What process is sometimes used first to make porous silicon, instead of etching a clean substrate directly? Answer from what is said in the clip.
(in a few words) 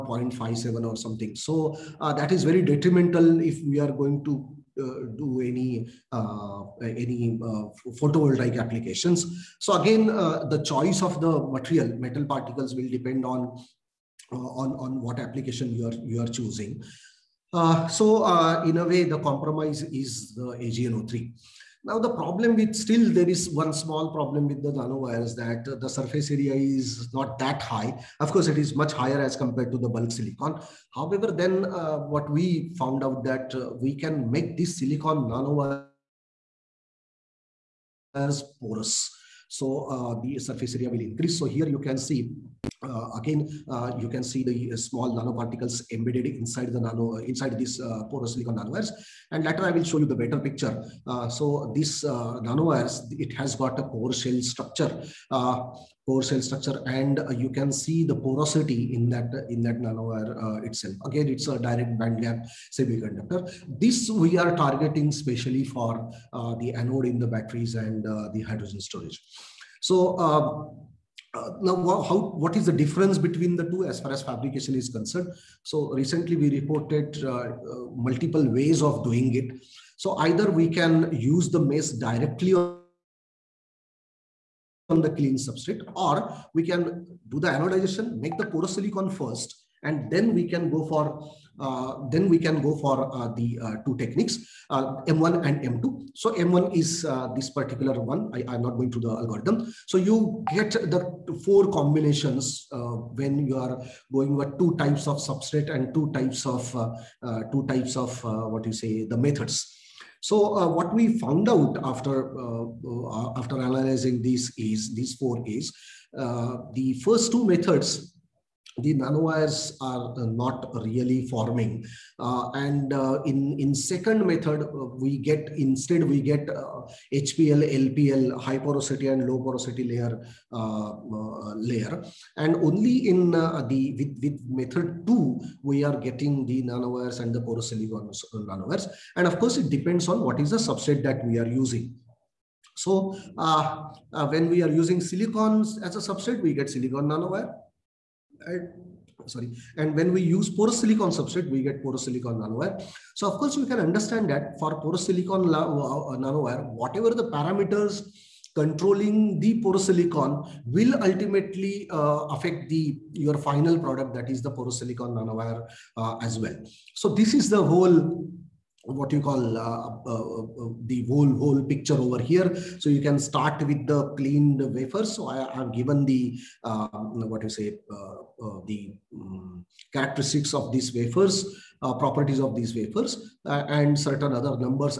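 anodization.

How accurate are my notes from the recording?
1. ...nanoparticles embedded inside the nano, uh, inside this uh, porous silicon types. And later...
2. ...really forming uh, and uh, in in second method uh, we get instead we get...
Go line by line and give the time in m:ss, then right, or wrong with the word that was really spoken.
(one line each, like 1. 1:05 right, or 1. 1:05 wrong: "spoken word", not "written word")
1. 0:45 wrong: "nanowires", not "types"
2. 2:00 right.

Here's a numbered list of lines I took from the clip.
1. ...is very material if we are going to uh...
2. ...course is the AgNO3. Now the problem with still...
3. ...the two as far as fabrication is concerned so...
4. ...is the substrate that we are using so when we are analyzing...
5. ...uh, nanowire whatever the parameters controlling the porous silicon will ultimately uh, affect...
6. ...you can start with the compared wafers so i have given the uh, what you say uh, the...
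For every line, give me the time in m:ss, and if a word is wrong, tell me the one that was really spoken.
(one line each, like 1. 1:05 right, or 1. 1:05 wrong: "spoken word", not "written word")
1. 0:02 wrong: "detrimental", not "material"
2. 0:19 wrong: "compromise", not "course"
3. 1:13 right
4. 2:20 wrong: "using", not "analyzing"
5. 2:35 right
6. 2:52 wrong: "cleaned", not "compared".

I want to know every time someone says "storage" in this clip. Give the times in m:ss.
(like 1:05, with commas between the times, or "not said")
1:08.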